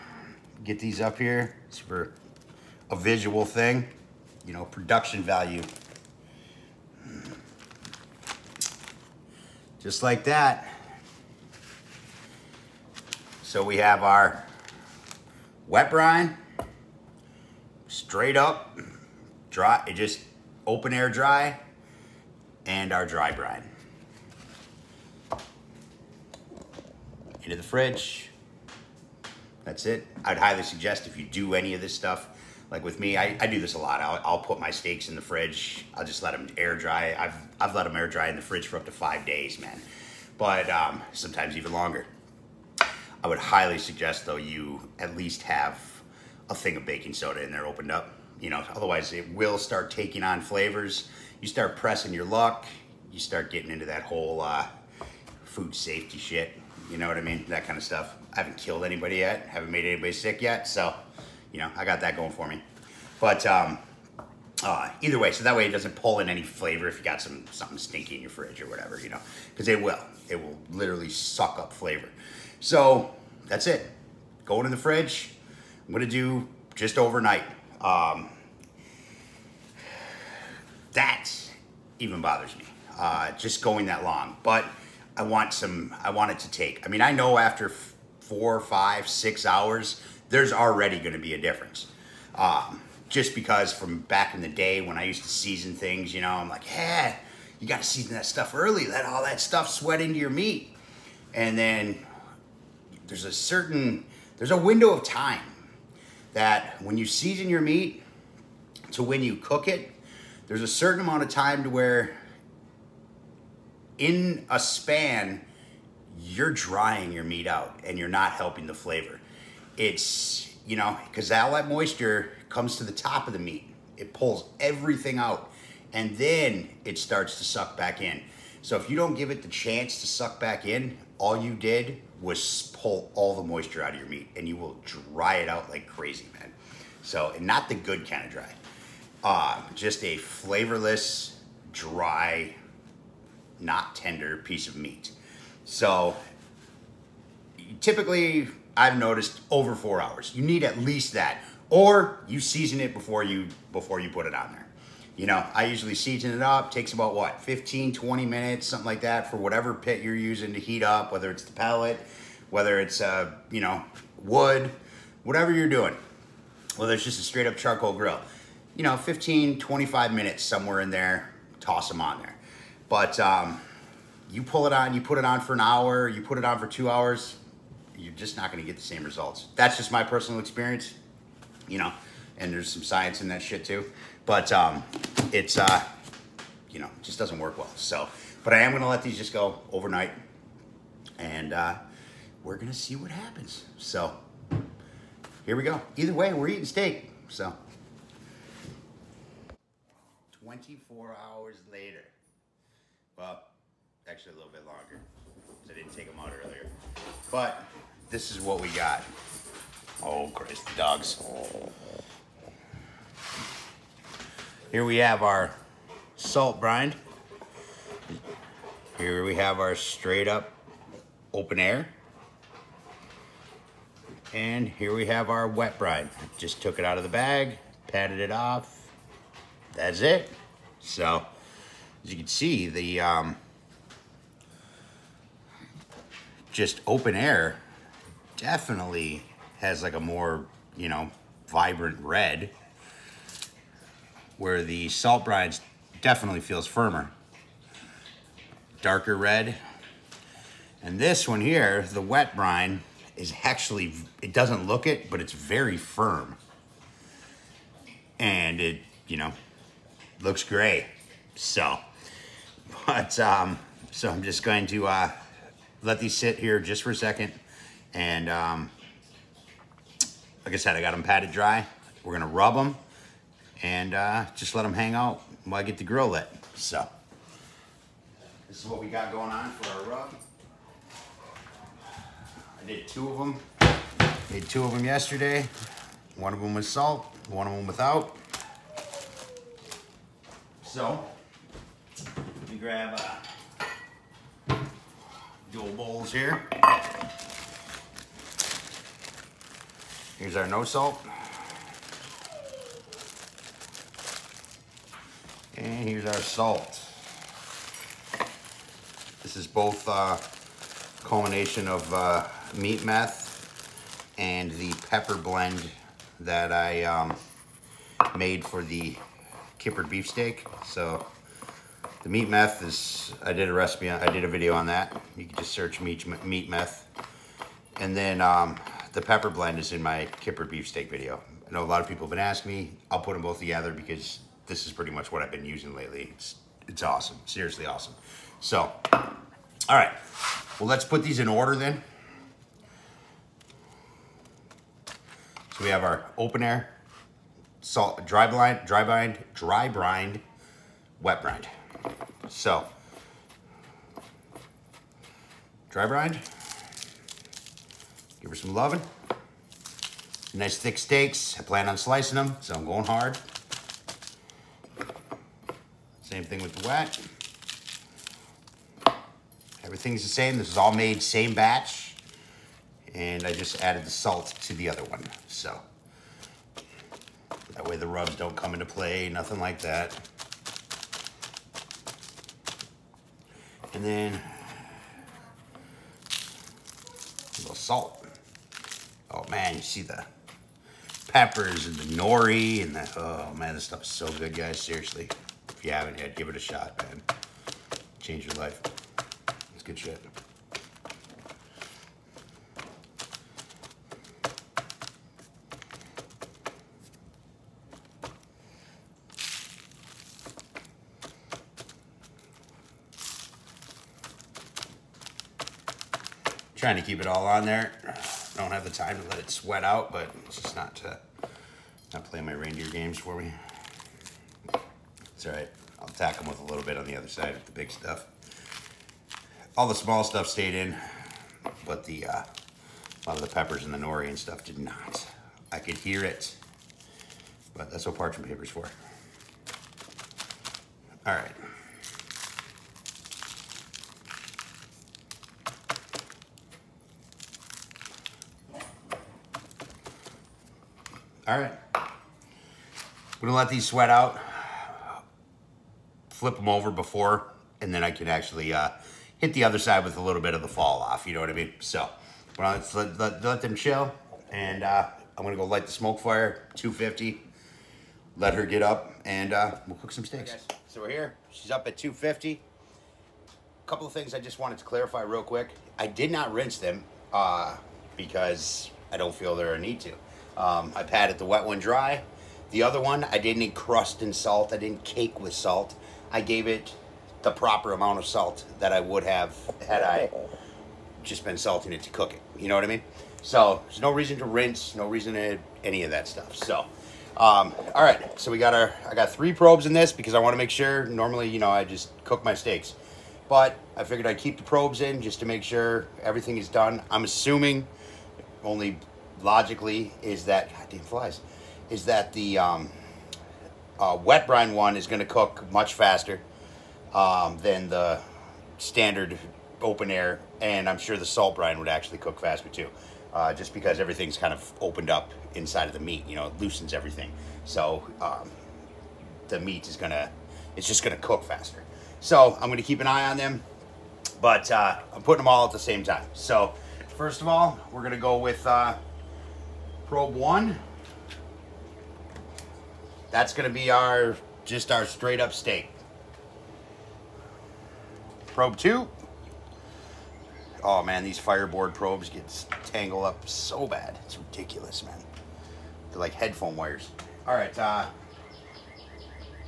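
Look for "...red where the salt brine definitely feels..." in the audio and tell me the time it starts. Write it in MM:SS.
04:02.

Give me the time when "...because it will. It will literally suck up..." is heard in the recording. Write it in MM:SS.
01:09.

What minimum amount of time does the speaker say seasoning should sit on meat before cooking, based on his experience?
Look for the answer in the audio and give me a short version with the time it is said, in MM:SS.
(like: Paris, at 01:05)
4 hours, at 02:29.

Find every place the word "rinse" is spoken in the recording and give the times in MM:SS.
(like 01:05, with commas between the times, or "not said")
07:56, 08:14.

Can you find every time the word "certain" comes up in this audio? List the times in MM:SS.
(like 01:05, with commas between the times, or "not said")
01:43, 01:50.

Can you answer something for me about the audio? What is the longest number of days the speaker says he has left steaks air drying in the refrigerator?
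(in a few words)
5 days.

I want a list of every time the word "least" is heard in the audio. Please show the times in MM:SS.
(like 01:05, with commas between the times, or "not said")
00:45, 02:30.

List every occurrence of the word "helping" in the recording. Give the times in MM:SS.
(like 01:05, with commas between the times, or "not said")
01:58.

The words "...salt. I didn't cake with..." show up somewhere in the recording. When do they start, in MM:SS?
08:04.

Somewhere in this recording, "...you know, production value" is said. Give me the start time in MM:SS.
00:04.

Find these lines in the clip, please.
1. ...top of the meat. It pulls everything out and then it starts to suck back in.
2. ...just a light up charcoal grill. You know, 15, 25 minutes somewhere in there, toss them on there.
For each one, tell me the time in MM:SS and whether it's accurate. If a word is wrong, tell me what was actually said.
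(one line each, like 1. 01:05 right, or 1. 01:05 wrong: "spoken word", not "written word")
1. 02:02 right
2. 02:47 wrong: "straight", not "light".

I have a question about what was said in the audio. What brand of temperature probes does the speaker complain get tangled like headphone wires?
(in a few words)
FireBoard.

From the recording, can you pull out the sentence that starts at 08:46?
You know, it loosens everything, so um, the meat is gonna, it's just gonna cook faster.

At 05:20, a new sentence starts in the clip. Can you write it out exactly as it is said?
So the meat meth is, I did a recipe, on, I did a video on that.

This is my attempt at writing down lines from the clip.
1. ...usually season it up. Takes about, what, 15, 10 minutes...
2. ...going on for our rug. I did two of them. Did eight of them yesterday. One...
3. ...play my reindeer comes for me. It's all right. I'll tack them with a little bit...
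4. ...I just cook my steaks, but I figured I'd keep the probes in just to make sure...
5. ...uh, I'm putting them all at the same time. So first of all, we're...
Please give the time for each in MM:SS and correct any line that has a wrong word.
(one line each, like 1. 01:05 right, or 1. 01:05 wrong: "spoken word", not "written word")
1. 02:35 wrong: "20", not "10"
2. 04:39 wrong: "two", not "eight"
3. 07:02 wrong: "games", not "comes"
4. 08:21 right
5. 08:54 right.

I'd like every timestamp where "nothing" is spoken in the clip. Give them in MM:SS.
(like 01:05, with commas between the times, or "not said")
06:19.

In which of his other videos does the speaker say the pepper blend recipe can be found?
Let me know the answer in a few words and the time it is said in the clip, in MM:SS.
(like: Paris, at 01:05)
Kippered beefsteak video, at 05:30.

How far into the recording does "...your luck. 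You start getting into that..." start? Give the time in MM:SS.
00:52.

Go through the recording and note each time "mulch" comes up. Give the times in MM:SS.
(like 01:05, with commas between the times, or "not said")
not said.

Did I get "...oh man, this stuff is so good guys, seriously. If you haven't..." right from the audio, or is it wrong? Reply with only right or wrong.
right.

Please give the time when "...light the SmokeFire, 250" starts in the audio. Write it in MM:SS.
07:45.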